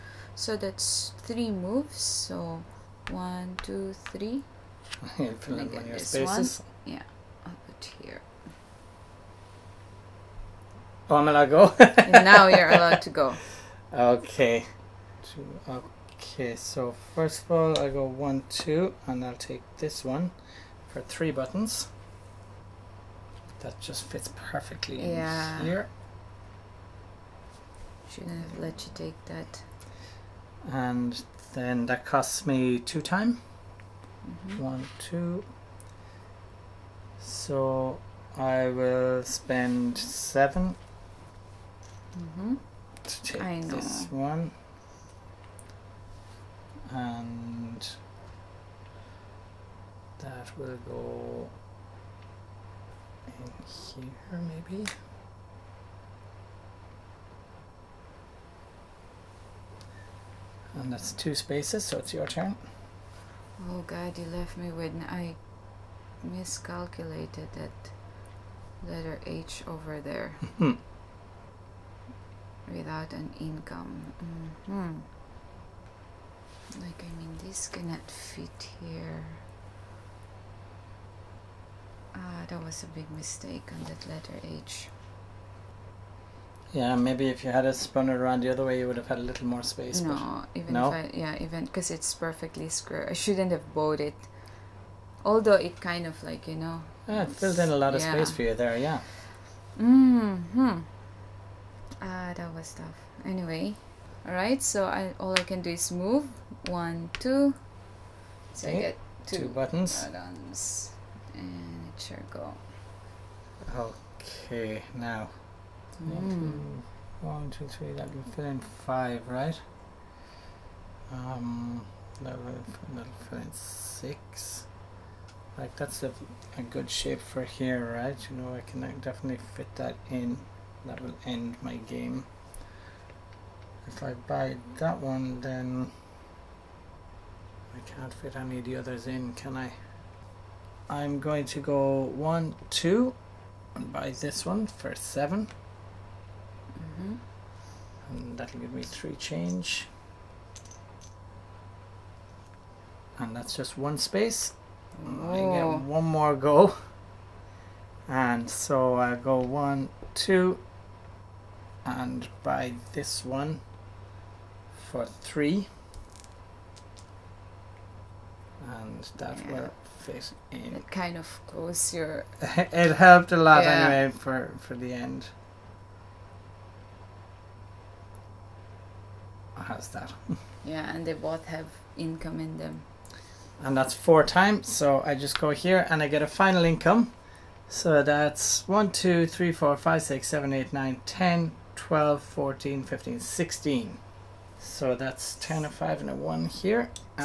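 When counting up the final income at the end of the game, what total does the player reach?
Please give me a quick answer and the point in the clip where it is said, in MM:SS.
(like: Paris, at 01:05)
16, at 03:13.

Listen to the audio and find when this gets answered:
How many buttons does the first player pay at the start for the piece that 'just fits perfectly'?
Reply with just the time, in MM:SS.
00:21.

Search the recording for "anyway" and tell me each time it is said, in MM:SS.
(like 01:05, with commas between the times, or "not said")
01:43, 02:53.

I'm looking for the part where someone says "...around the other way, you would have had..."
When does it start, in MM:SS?
01:28.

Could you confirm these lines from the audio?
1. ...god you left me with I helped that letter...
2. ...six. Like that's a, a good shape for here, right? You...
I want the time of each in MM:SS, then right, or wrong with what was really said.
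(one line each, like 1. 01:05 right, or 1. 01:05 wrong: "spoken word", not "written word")
1. 01:03 wrong: "miscalculated", not "helped"
2. 02:03 right.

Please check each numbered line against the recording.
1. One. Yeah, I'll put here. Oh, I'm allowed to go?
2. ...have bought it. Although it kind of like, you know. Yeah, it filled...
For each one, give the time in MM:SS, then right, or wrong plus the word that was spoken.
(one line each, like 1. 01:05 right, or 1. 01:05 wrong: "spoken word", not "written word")
1. 00:06 right
2. 01:33 right.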